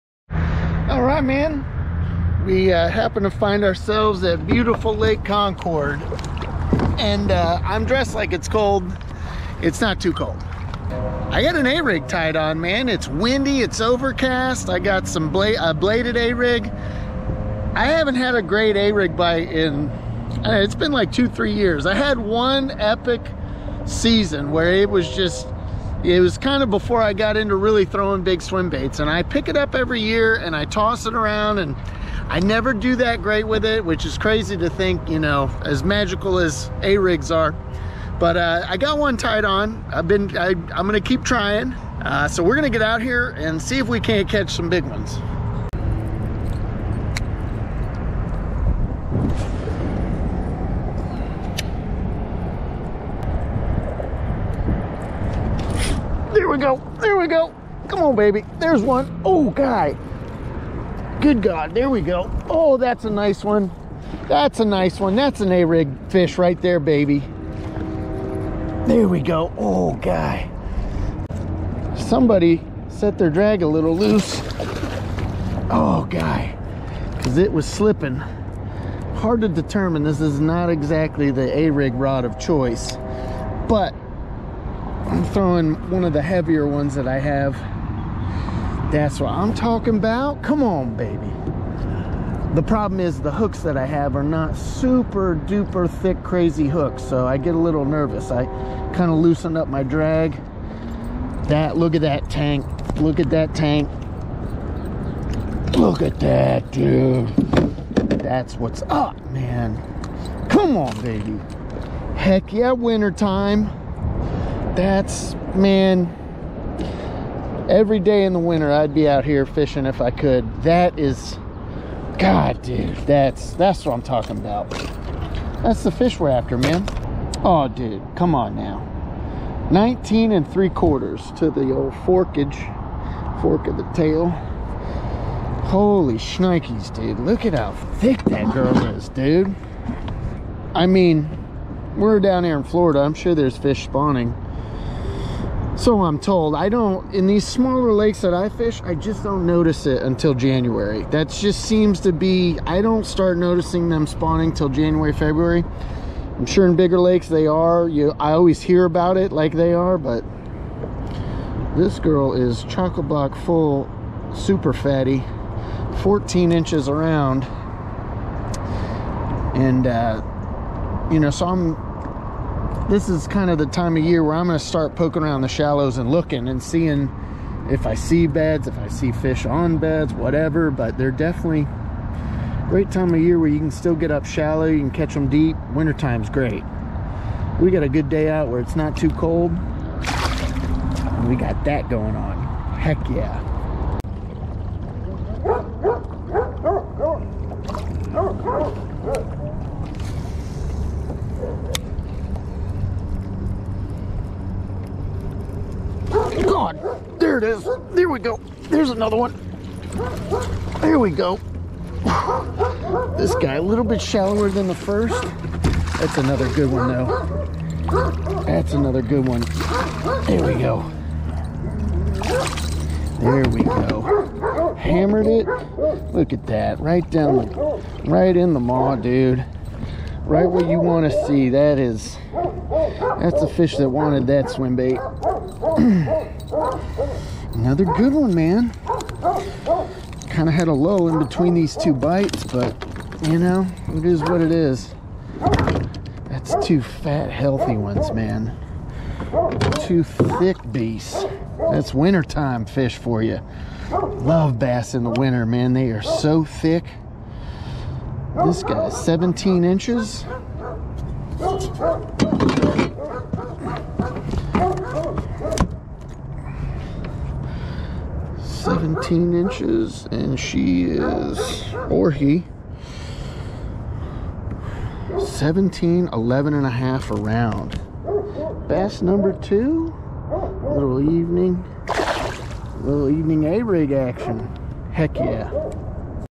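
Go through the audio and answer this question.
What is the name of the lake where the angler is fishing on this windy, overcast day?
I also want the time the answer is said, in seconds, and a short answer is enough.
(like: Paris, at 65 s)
Lake Concord, at 4 s.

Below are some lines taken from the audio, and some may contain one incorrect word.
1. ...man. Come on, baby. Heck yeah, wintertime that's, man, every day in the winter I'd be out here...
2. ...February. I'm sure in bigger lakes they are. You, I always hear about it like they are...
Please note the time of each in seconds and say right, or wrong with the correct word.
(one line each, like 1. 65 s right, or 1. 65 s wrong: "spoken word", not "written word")
1. 109 s right
2. 155 s right.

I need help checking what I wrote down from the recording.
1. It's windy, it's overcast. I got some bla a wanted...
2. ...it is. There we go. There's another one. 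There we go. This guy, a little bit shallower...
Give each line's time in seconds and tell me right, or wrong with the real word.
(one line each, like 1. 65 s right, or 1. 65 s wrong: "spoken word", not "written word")
1. 12 s wrong: "bladed", not "wanted"
2. 207 s right.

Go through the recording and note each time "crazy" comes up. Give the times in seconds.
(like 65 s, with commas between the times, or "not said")
34 s, 96 s.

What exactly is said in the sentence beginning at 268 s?
Seventeen inches, and she is, or he, 17, 11 and a half around.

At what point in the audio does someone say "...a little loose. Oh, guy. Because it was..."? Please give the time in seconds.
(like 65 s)
73 s.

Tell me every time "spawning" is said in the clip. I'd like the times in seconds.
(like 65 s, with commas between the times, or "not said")
143 s, 154 s.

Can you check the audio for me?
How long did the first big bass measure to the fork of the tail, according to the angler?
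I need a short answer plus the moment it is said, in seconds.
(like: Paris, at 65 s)
19 3/4 inches, at 129 s.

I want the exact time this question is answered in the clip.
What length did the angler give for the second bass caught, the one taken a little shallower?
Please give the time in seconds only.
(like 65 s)
258 s.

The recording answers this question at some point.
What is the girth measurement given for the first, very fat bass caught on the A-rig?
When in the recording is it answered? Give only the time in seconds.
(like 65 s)
166 s.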